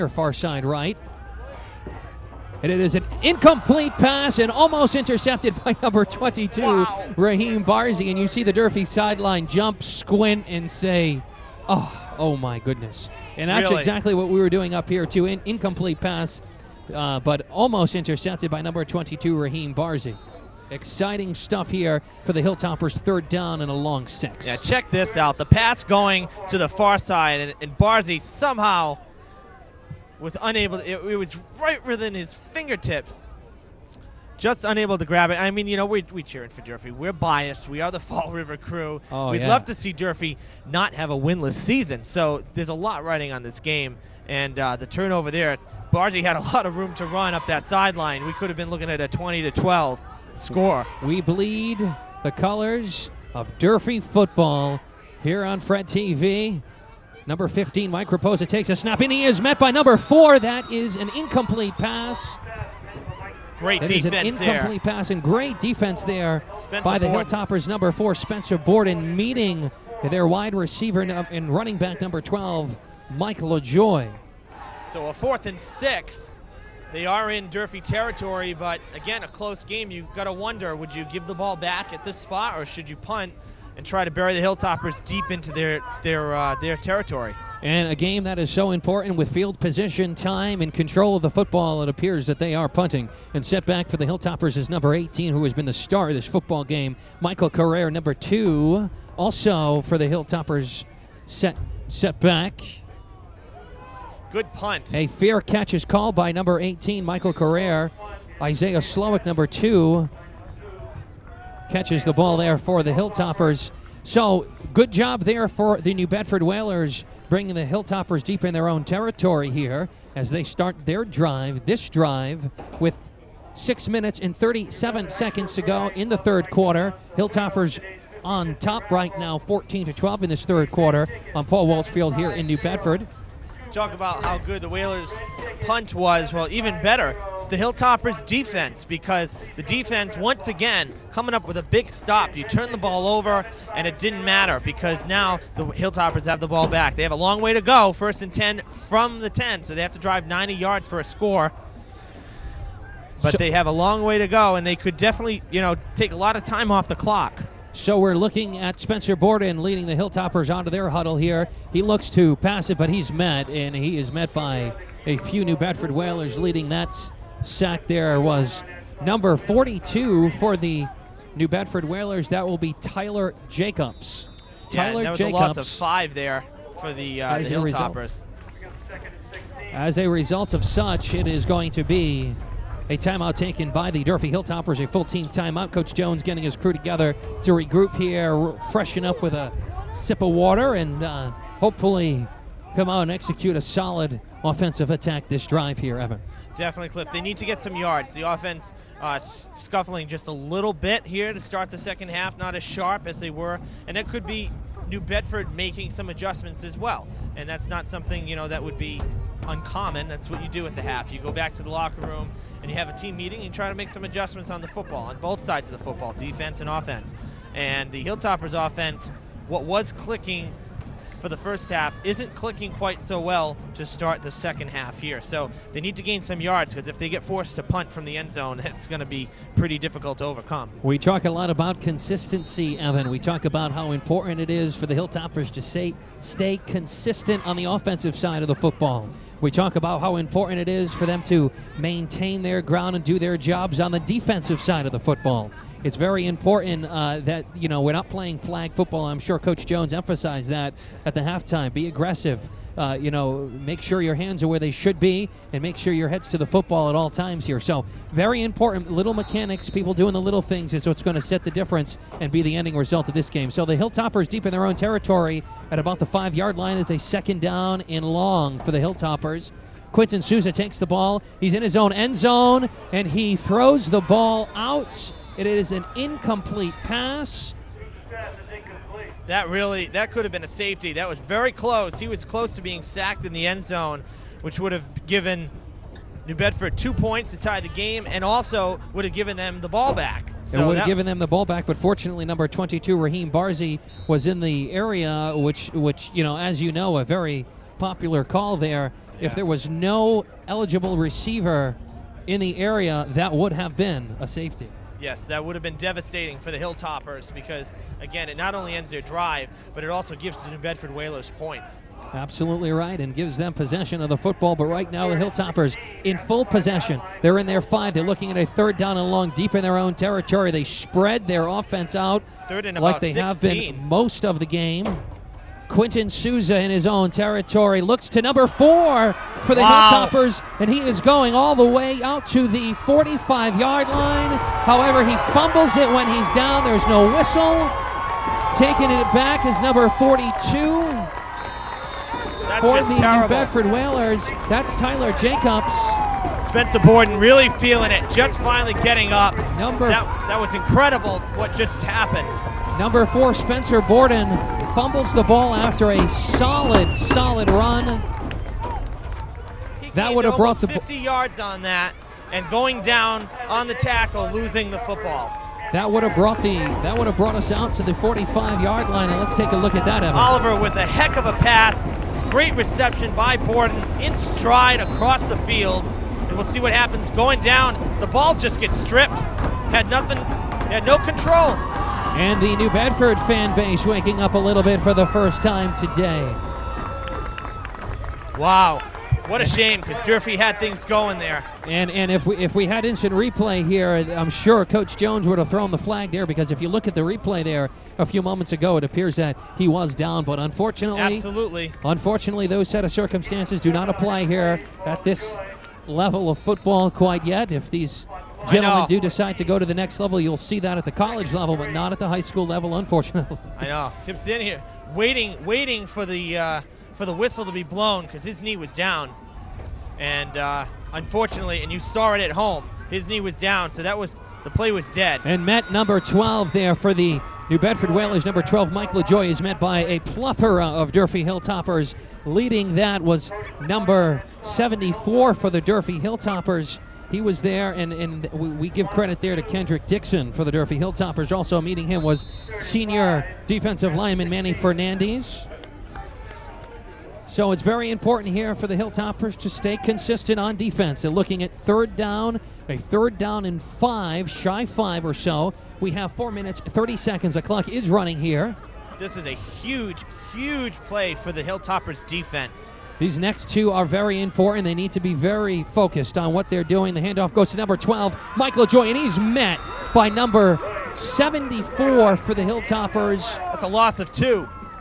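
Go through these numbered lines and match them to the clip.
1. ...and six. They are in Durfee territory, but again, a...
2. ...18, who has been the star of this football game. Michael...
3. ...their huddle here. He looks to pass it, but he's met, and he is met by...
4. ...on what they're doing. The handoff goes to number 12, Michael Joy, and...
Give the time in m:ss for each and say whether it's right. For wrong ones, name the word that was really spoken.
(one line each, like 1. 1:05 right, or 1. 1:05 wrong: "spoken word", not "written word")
1. 1:15 right
2. 1:34 right
3. 2:40 right
4. 7:46 right.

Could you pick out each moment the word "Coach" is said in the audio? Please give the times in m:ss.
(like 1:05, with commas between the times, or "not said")
3:05, 4:09, 6:34.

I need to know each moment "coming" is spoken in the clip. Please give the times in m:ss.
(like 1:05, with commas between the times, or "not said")
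2:21.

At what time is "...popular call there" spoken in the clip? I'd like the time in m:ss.
4:57.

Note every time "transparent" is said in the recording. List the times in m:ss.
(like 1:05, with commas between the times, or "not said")
not said.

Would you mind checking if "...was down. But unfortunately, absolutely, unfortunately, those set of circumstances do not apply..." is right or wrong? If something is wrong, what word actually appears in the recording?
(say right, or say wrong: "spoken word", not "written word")
right.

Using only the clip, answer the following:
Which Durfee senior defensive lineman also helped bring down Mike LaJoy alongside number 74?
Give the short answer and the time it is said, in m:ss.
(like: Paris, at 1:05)
Manny Fernandez, at 7:24.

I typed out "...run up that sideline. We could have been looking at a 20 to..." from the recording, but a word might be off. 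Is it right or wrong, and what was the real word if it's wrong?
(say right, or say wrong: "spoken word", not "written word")
right.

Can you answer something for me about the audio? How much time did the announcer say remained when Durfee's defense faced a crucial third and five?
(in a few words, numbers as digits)
4 minutes 30 seconds.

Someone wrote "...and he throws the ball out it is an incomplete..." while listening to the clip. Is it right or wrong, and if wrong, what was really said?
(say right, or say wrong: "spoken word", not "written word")
right.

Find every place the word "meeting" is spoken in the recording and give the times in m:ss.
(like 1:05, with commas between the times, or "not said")
1:09, 3:33, 7:21.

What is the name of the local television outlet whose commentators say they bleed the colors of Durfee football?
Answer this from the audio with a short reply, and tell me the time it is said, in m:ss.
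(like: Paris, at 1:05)
FRED TV, at 0:55.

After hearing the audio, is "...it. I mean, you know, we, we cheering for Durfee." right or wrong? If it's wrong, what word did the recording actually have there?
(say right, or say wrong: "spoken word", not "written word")
right.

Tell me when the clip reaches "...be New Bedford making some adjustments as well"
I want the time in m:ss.
3:24.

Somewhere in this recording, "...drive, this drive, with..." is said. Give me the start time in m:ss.
2:01.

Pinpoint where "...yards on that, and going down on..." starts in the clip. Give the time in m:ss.
6:00.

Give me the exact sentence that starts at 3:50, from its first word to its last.
We talk a lot about consistency, Evan.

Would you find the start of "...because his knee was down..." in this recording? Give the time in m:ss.
6:58.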